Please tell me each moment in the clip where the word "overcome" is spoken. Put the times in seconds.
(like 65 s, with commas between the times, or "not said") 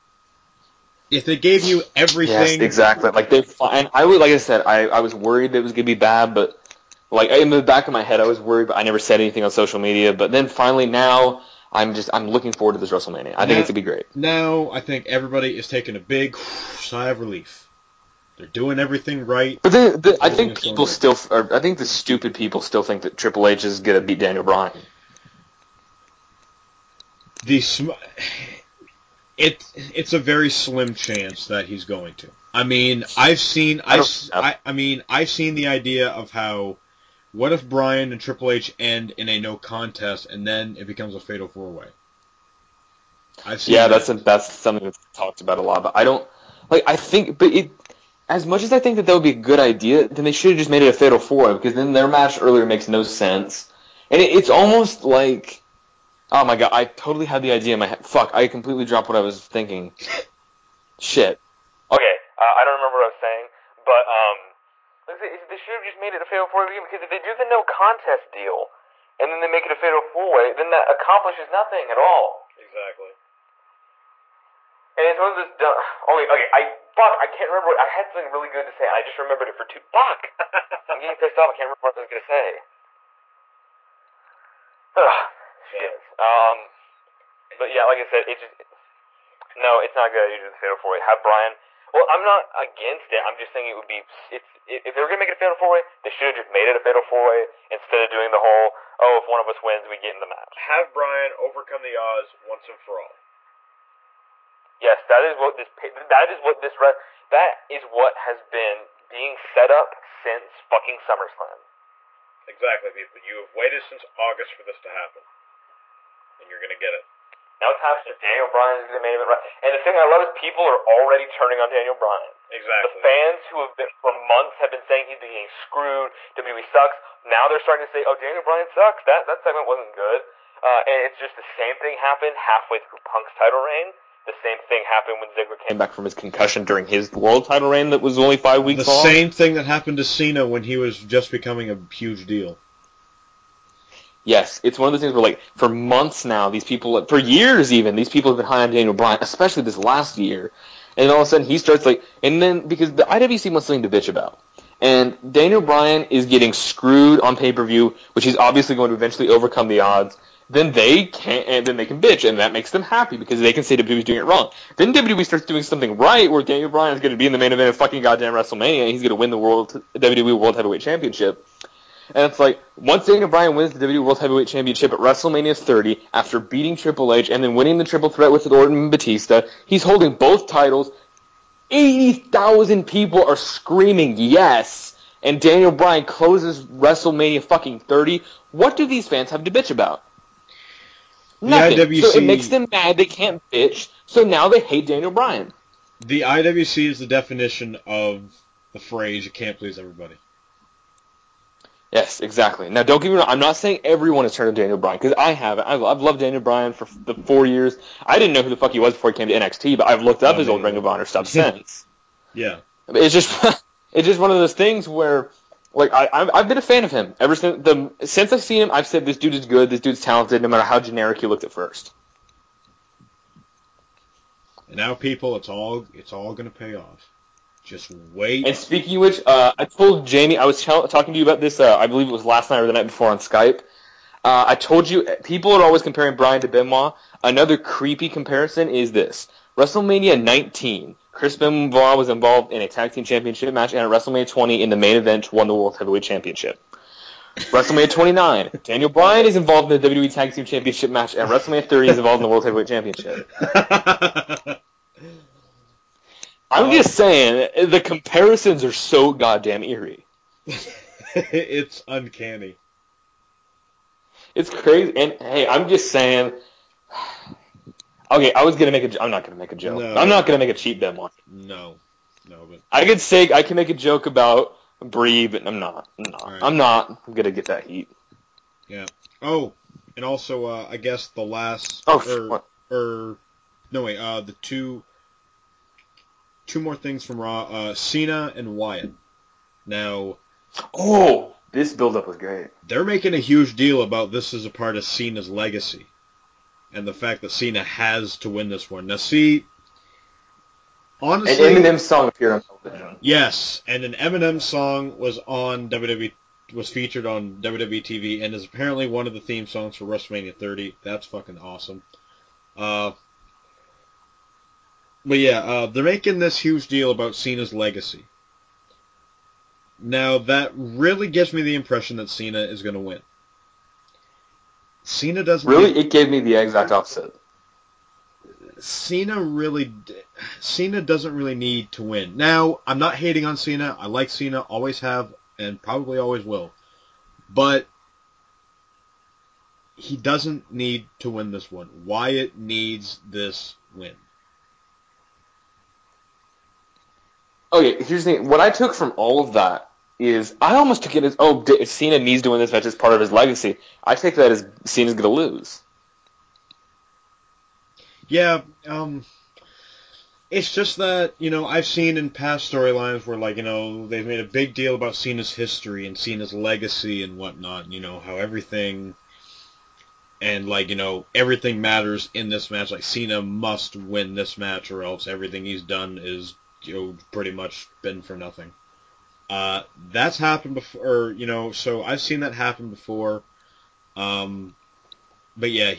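101 s, 159 s.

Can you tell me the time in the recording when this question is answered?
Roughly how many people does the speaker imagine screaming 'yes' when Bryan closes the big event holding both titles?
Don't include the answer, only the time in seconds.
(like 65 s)
181 s.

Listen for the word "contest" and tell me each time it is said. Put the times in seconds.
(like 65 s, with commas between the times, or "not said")
39 s, 67 s.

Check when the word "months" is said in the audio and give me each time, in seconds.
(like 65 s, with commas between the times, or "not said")
124 s, 145 s.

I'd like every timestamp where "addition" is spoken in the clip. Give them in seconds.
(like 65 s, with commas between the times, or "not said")
not said.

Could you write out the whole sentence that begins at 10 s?
But then finally now, I'm just I'm looking forward to this WrestleMania.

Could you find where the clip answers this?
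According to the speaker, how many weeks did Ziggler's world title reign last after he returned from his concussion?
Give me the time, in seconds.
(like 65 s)
138 s.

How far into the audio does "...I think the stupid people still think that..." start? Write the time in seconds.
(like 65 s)
21 s.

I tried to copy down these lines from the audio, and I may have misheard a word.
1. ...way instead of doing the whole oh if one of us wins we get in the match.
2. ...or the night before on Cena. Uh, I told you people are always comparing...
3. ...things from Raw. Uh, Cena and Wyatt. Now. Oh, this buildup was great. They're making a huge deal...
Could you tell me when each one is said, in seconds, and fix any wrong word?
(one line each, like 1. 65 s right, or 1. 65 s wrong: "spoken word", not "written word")
1. 97 s right
2. 232 s wrong: "Skype", not "Cena"
3. 286 s right.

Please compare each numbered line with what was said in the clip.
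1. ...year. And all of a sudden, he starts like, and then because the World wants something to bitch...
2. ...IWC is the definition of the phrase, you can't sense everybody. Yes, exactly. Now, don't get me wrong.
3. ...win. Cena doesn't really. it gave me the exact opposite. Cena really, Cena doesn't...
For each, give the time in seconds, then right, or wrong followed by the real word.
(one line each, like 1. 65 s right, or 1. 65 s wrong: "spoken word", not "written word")
1. 150 s wrong: "IWC", not "World"
2. 196 s wrong: "please", not "sense"
3. 322 s right.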